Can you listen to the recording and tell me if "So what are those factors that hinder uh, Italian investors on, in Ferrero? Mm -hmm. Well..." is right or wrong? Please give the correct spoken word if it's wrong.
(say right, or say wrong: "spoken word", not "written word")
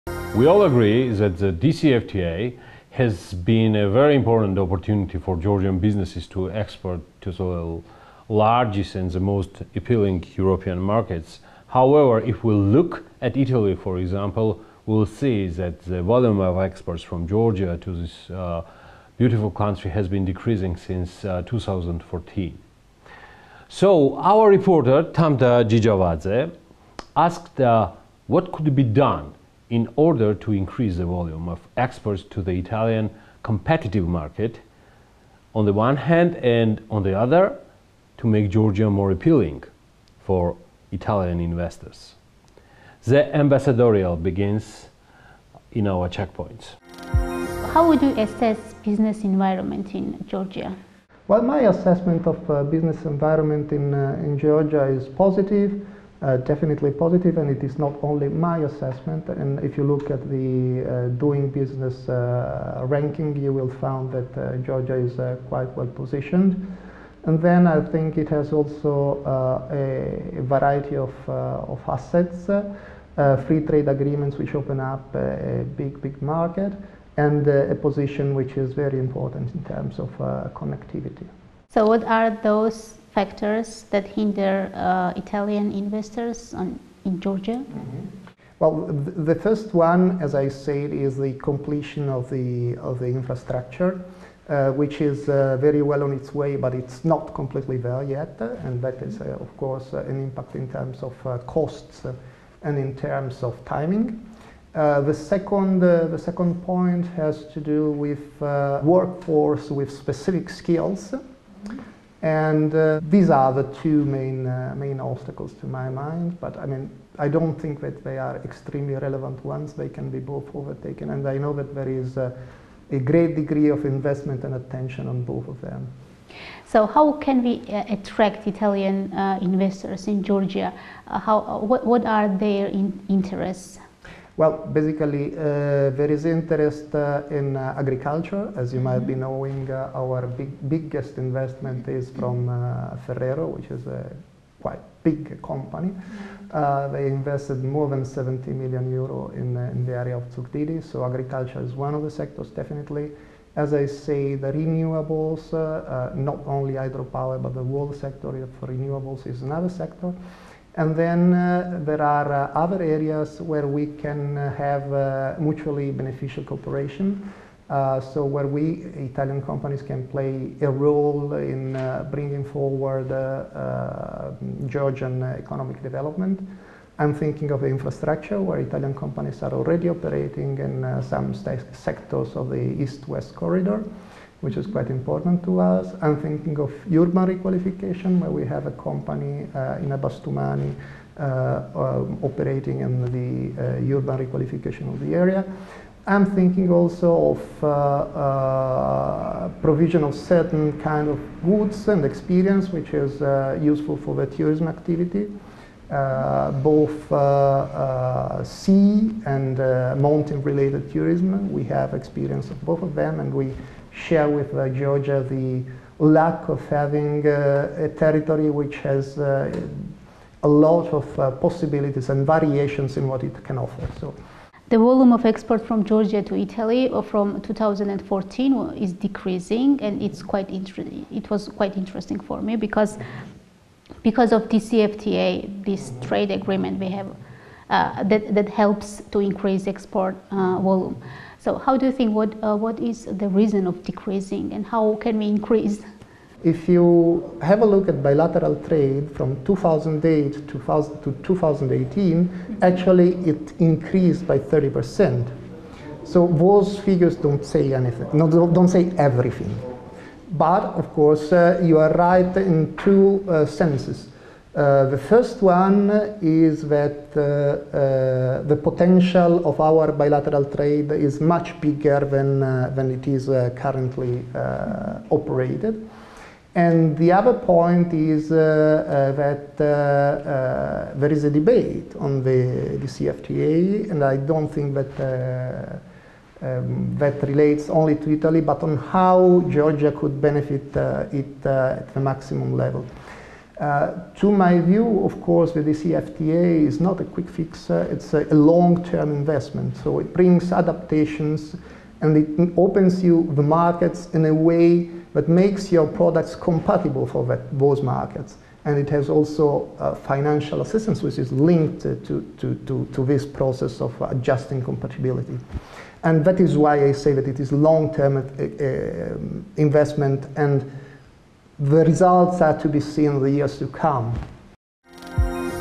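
wrong: "Georgia", not "Ferrero".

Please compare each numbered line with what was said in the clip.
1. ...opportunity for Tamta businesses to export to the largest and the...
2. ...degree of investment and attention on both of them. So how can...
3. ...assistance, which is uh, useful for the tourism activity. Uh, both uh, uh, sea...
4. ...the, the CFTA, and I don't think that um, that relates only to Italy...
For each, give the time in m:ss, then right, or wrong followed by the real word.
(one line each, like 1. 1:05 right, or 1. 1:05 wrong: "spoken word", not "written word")
1. 0:04 wrong: "Georgian", not "Tamta"
2. 2:03 right
3. 3:22 wrong: "experience", not "assistance"
4. 4:42 right.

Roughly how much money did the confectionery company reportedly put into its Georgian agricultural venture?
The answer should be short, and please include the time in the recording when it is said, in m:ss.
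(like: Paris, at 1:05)
more than 70 million euro, at 2:27.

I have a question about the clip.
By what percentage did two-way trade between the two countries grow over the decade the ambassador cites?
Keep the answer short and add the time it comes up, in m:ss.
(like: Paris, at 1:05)
30%, at 4:14.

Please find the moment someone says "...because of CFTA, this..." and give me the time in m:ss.
3:54.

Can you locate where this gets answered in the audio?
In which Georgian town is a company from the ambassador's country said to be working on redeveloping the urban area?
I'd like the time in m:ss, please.
3:09.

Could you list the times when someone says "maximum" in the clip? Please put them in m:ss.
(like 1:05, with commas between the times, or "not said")
4:52.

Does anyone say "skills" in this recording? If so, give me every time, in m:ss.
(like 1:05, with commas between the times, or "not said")
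1:50.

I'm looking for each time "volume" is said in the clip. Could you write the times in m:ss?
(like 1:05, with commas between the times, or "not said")
0:16, 0:31, 3:44, 4:00.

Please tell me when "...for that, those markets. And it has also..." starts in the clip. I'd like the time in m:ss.
5:07.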